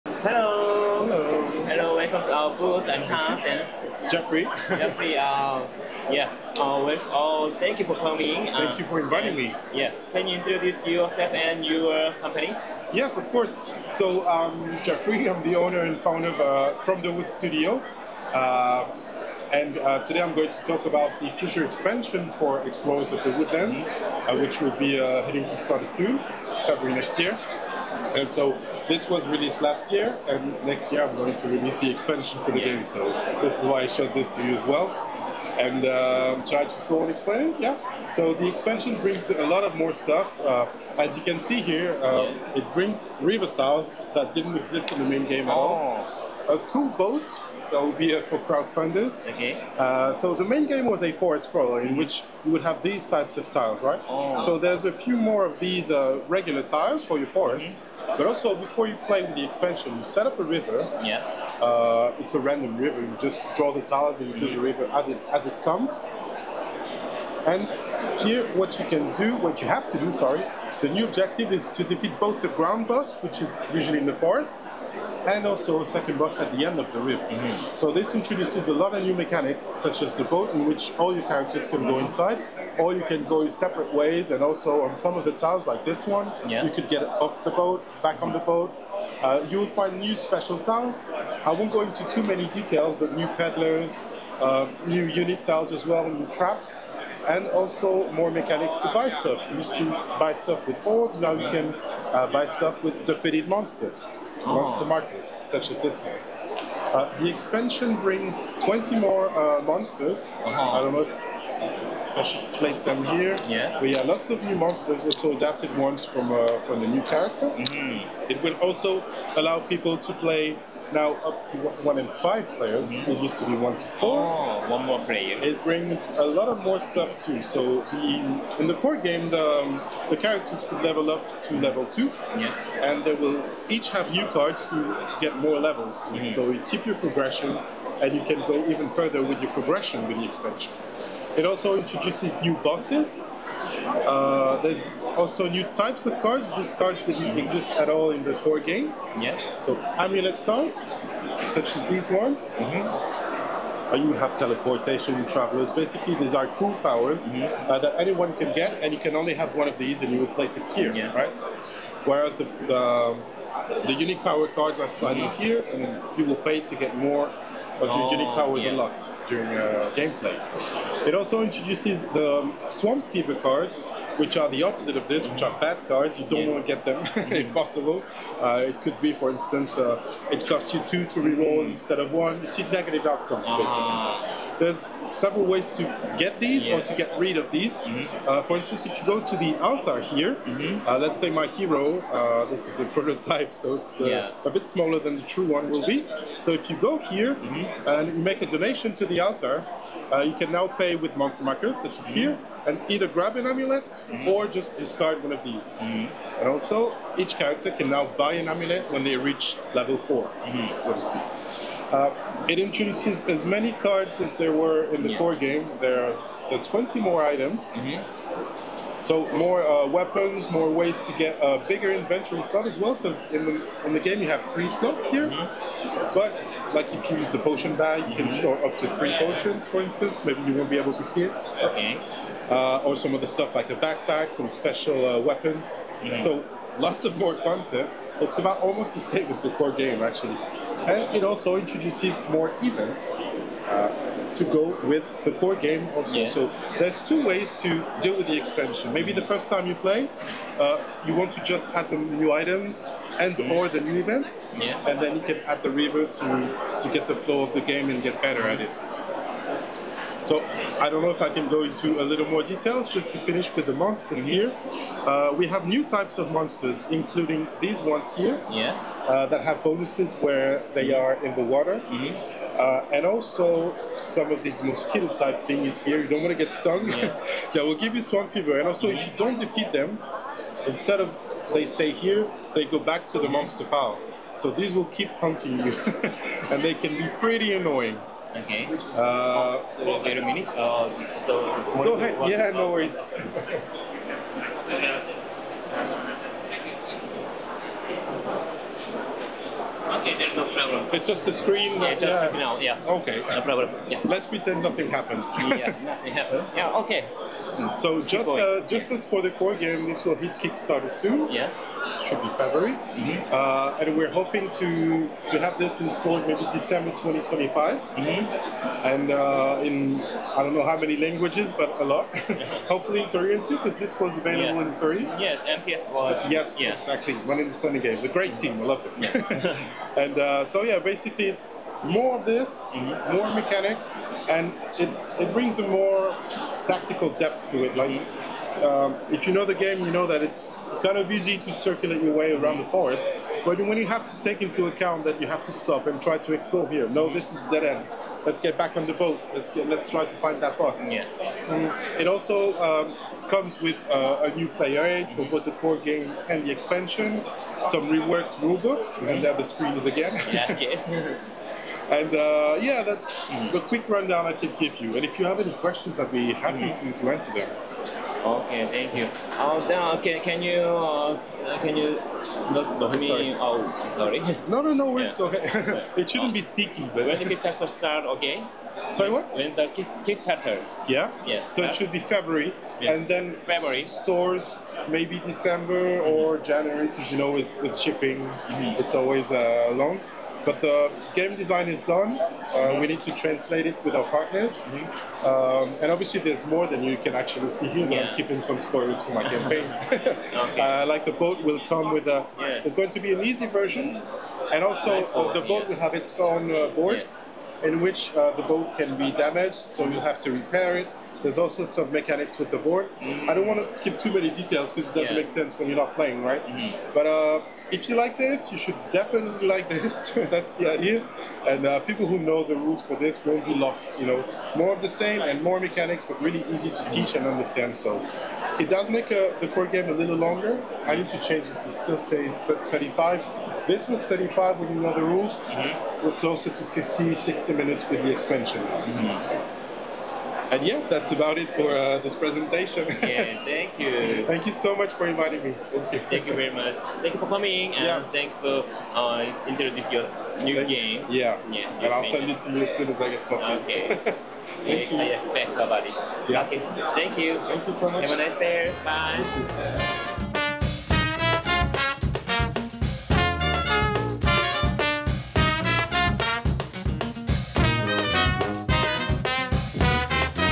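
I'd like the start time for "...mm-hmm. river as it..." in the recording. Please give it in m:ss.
1:04.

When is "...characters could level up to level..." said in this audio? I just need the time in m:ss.
2:10.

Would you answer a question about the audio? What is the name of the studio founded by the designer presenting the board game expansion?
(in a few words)
From the Woods Studio.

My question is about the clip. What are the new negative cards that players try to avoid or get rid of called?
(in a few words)
Swamp Fever cards.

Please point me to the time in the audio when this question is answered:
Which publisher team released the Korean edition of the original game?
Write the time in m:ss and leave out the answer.
5:27.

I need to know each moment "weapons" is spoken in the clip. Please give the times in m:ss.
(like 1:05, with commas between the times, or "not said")
3:39, 3:55.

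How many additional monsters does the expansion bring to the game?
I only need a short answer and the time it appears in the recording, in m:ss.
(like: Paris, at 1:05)
20, at 1:48.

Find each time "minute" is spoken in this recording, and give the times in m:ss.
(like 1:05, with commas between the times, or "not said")
4:50, 7:17.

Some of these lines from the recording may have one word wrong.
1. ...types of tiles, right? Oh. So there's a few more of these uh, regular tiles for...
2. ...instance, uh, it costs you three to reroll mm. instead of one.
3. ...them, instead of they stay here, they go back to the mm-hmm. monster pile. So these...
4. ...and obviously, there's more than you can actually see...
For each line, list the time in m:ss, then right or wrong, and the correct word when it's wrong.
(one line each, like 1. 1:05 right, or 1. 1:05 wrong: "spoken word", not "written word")
1. 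0:53 right
2. 2:59 wrong: "two", not "three"
3. 4:39 right
4. 6:35 right.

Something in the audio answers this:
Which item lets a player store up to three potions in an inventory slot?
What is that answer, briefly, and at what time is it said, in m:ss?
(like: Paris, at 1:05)
Potion bag, at 3:47.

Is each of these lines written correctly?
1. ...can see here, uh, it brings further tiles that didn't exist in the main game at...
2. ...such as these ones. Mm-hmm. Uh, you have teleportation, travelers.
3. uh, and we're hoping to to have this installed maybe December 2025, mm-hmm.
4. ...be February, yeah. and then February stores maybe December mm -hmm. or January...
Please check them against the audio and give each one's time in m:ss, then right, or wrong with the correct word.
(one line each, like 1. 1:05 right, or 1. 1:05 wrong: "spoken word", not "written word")
1. 0:41 wrong: "river", not "further"
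2. 2:31 right
3. 5:13 right
4. 6:21 right.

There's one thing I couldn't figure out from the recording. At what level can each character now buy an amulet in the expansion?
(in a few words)
Level 4.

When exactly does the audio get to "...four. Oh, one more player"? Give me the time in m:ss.
2:03.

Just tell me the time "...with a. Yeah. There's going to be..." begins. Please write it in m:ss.
6:41.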